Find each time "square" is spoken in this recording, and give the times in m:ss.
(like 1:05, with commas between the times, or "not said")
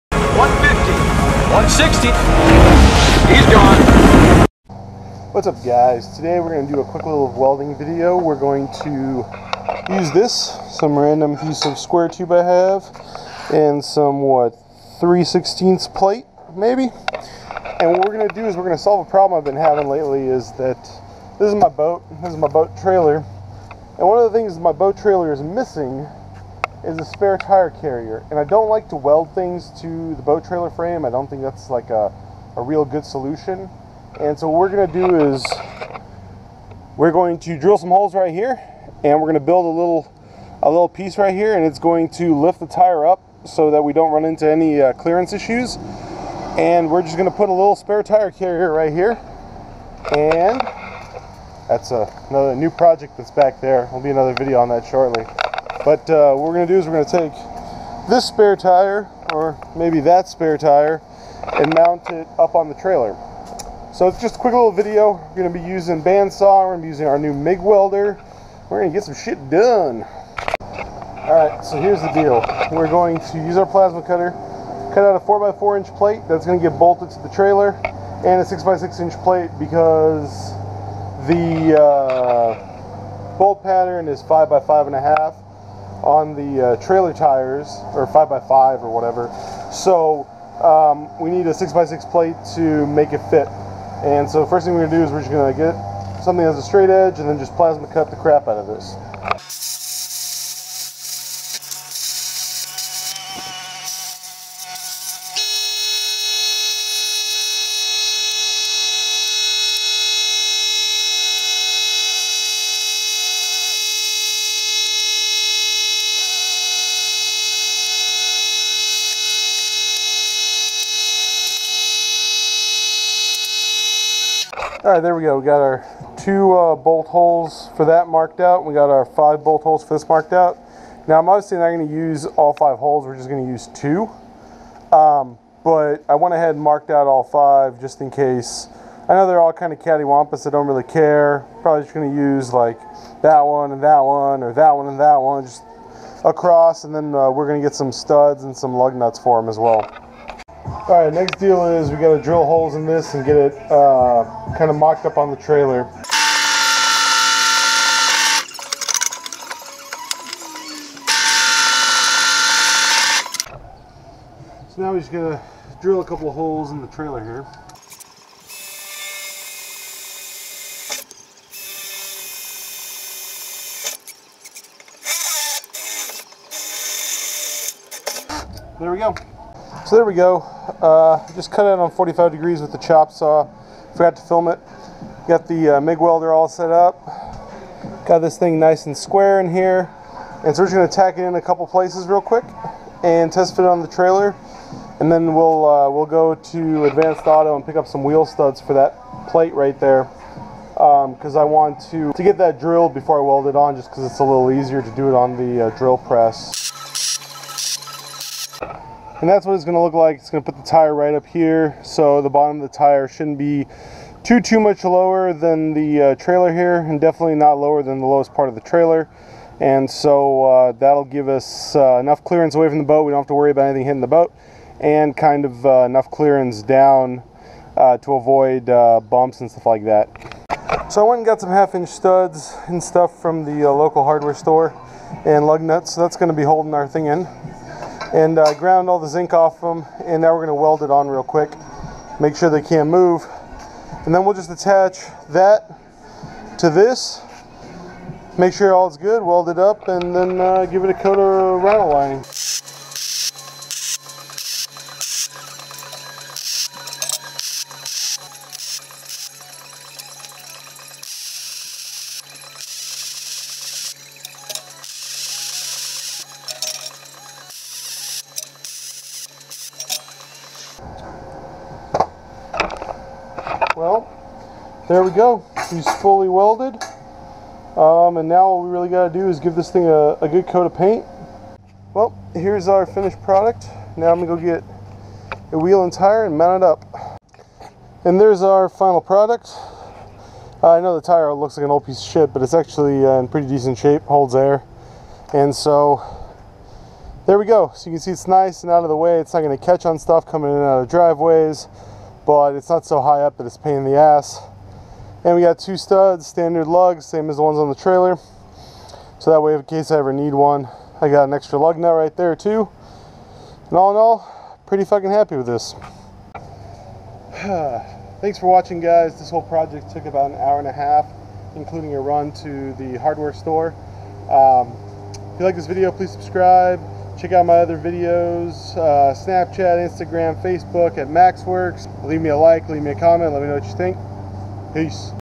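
0:11, 3:08.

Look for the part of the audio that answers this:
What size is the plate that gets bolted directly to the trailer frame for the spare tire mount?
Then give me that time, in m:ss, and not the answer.
1:15.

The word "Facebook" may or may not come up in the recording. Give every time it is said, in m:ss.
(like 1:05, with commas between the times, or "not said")
5:30.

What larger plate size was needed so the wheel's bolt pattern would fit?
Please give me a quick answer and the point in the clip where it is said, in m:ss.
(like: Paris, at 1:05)
6x6 inch, at 1:18.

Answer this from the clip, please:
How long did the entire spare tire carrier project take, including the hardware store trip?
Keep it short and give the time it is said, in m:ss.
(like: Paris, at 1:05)
an hour and a half, at 5:20.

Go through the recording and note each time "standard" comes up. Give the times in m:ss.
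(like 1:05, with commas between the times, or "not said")
5:06.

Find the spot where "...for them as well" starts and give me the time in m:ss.
2:29.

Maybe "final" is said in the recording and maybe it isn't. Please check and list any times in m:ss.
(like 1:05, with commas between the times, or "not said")
4:48.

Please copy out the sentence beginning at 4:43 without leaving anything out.
Now I'm going to go get a wheel and tire and mount it up.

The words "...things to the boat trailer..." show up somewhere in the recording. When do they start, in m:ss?
0:29.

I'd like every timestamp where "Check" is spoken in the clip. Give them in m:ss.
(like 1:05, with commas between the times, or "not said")
5:27.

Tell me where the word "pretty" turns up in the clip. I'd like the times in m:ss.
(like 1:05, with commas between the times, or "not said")
4:53, 5:14.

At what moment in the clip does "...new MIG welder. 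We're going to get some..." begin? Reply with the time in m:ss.
1:07.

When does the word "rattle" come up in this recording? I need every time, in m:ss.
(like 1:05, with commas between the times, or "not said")
4:11.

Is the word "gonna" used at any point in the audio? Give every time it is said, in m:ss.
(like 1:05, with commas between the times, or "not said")
0:34, 0:39, 0:47, 3:10.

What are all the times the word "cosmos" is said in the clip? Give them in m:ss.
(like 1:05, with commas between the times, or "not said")
not said.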